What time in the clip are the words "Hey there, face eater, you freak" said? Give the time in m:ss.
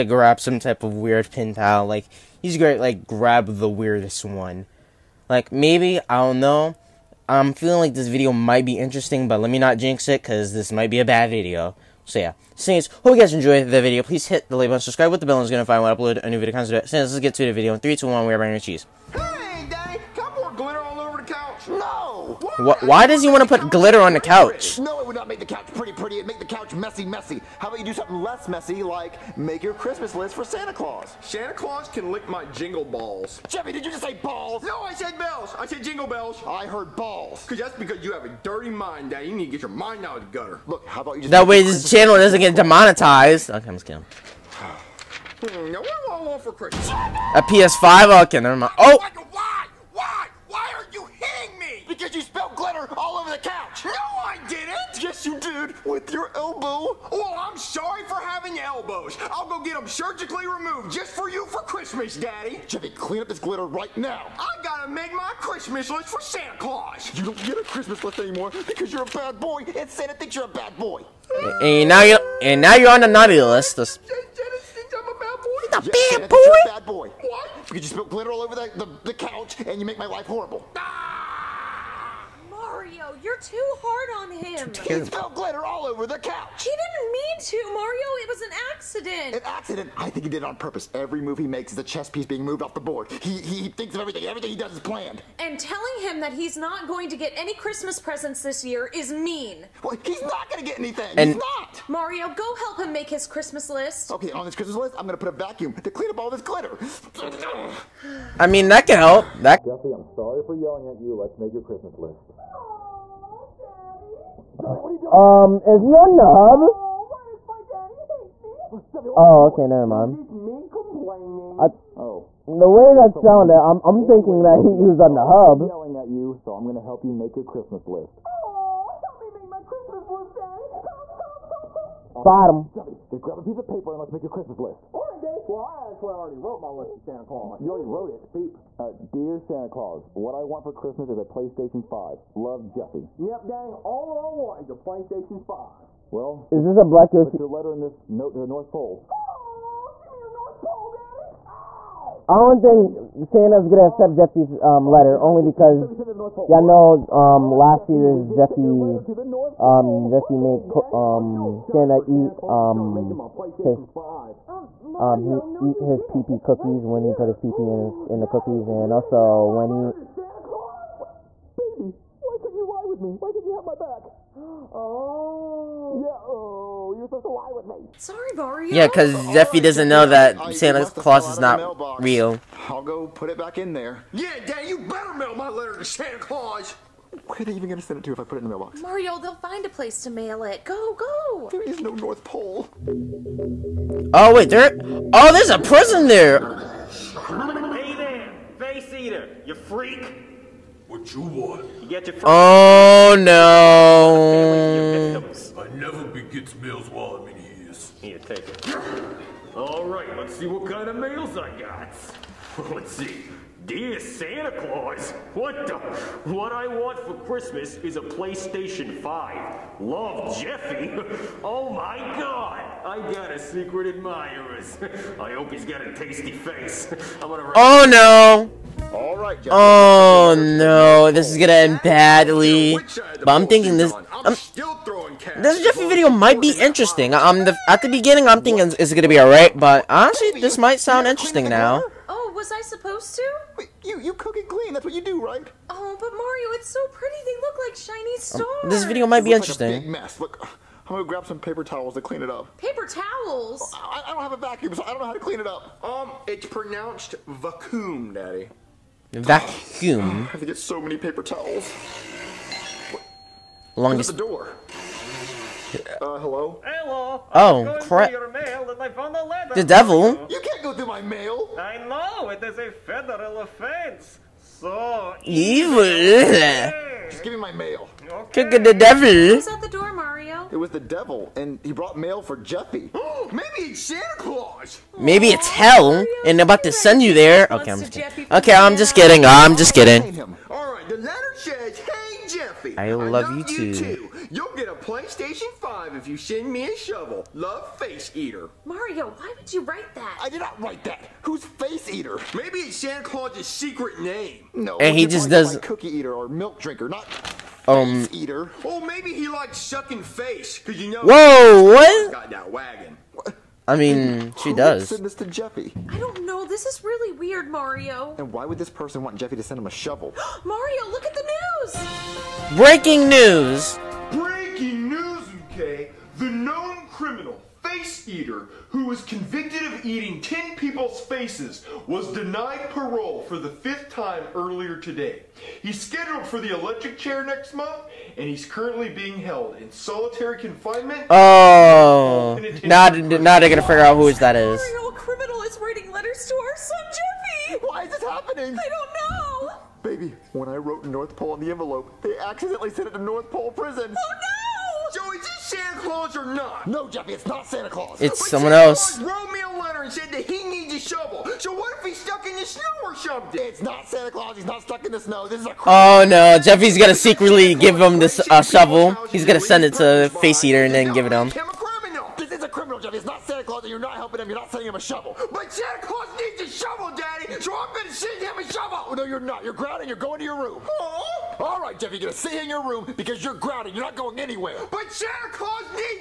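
3:16.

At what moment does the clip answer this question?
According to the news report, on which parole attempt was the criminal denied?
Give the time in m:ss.
5:33.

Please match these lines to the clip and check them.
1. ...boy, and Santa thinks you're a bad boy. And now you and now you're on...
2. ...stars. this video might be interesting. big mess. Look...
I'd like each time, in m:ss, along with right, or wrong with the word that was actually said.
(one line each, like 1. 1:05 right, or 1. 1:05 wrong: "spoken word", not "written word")
1. 1:09 right
2. 4:08 right.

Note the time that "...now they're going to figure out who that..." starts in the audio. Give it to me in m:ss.
5:42.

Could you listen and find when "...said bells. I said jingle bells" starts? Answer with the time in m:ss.
0:34.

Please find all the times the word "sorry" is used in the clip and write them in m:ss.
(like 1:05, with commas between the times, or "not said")
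0:57, 1:50, 2:57.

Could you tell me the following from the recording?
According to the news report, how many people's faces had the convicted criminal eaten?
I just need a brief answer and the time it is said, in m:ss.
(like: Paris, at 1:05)
10, at 5:30.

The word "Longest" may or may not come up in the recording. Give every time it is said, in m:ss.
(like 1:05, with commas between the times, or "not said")
4:23.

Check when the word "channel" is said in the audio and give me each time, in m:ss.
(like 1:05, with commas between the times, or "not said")
0:41.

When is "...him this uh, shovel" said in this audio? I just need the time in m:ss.
6:07.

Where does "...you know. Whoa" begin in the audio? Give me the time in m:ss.
5:10.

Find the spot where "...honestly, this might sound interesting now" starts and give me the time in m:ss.
3:59.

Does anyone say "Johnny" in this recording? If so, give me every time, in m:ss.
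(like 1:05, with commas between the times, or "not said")
1:54, 1:58.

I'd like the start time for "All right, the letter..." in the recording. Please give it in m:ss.
4:50.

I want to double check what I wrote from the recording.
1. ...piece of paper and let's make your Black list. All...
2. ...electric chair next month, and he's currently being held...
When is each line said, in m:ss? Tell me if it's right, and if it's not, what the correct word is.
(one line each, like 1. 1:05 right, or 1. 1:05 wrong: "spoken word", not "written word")
1. 2:13 wrong: "Christmas", not "Black"
2. 5:36 right.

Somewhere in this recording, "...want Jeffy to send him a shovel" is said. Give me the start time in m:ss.
5:19.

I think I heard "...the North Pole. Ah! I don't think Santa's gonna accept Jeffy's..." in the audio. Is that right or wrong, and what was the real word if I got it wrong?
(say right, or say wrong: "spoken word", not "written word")
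right.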